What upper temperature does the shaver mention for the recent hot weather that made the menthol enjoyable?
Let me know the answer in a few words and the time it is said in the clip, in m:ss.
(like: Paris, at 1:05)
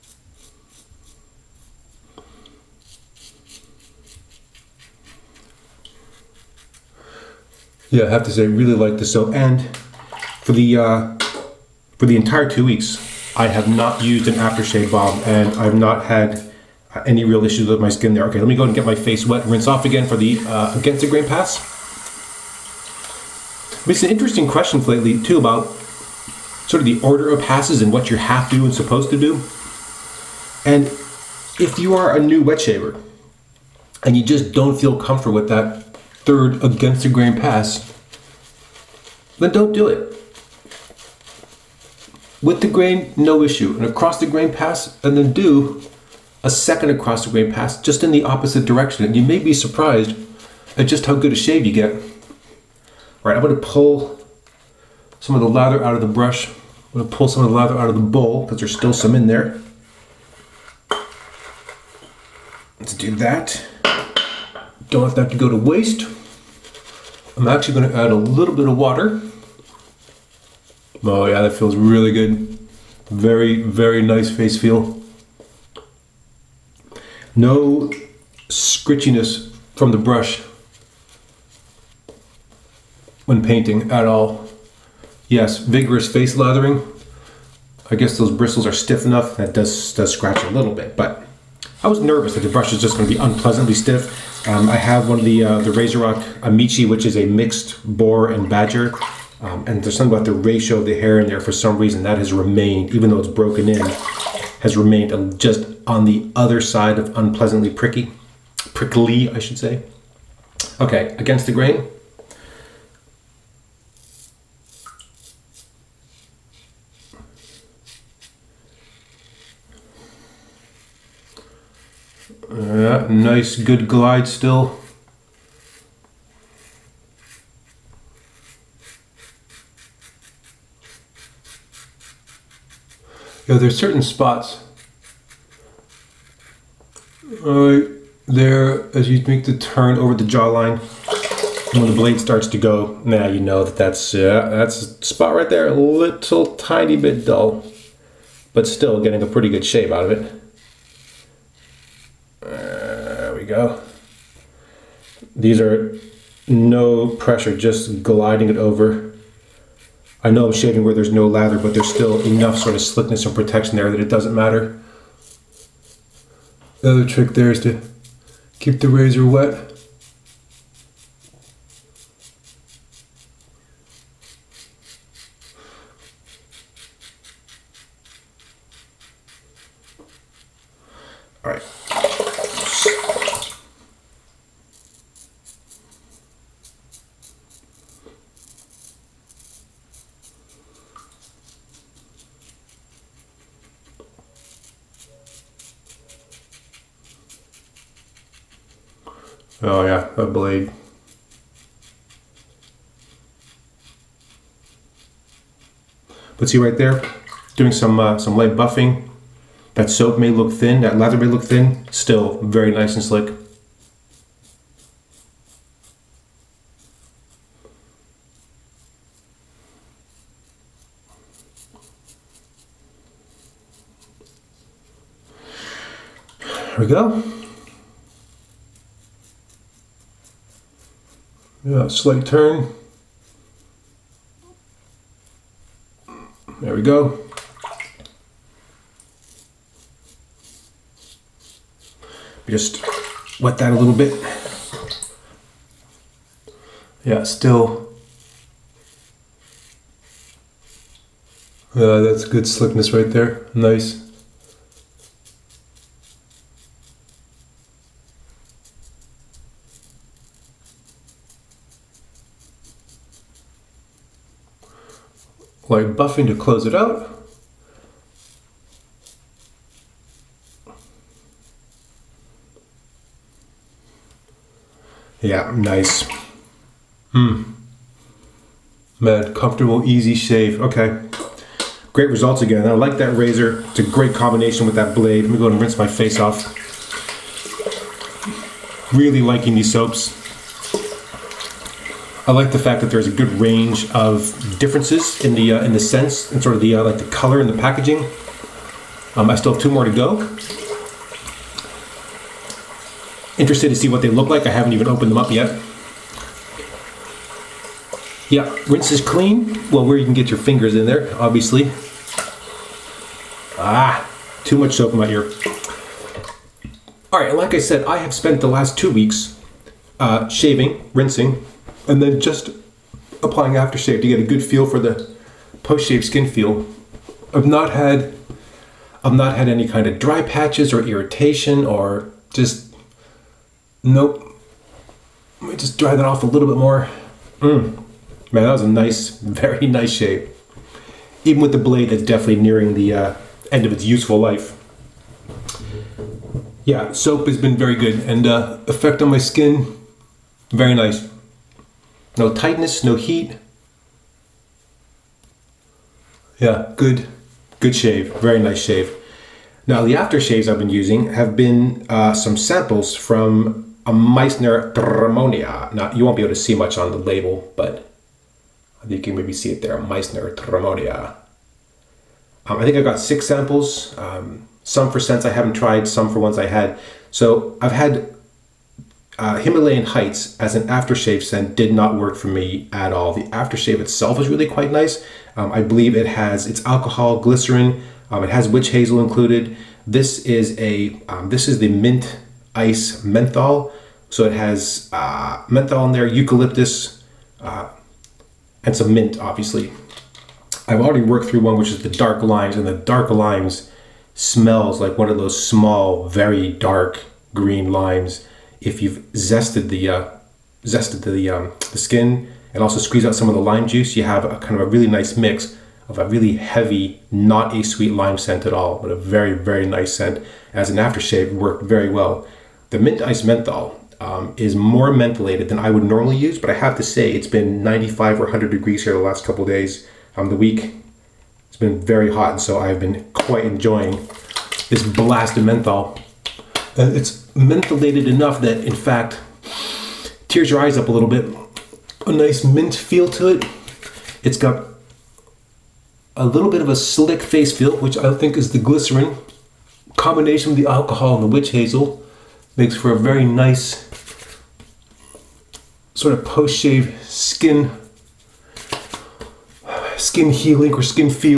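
100 degrees, at 7:08.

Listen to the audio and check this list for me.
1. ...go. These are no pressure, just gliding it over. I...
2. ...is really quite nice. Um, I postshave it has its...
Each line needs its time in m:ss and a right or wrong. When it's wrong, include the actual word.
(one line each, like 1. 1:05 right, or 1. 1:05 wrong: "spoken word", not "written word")
1. 2:33 right
2. 6:24 wrong: "believe", not "postshave".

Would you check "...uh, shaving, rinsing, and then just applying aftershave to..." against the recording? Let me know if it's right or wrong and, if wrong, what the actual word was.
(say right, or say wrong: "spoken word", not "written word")
right.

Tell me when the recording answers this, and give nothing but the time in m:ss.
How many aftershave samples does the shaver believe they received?
6:12.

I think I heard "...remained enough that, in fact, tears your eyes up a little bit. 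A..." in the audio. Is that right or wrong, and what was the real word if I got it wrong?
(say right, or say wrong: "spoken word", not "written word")
wrong: "mentholated", not "remained".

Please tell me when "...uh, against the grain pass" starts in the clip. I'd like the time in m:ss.
0:20.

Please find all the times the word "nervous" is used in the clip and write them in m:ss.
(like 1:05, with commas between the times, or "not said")
1:31.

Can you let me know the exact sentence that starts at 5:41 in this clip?
Even with the blade that's definitely nearing the uh, end of its useful life.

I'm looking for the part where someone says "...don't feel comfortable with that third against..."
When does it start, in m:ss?
0:34.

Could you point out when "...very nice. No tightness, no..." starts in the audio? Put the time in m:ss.
5:50.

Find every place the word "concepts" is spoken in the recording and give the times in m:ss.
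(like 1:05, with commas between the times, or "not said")
not said.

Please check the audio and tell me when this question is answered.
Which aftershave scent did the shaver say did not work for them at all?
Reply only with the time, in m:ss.
6:19.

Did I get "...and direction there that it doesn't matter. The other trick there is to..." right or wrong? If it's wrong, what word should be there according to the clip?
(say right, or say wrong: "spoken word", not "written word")
wrong: "protection", not "direction".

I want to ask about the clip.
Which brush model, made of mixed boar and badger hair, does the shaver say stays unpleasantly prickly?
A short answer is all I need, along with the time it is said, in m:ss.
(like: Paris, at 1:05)
Razorock Amici, at 1:35.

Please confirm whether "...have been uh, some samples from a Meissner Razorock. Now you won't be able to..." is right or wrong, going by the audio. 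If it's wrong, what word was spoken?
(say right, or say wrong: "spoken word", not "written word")
wrong: "Tremonia", not "Razorock".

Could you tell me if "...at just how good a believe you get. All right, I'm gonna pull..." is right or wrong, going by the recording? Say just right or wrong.
wrong.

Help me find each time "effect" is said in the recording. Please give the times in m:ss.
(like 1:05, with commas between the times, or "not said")
5:48.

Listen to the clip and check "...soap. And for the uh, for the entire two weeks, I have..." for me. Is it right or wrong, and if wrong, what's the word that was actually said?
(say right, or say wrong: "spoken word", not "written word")
right.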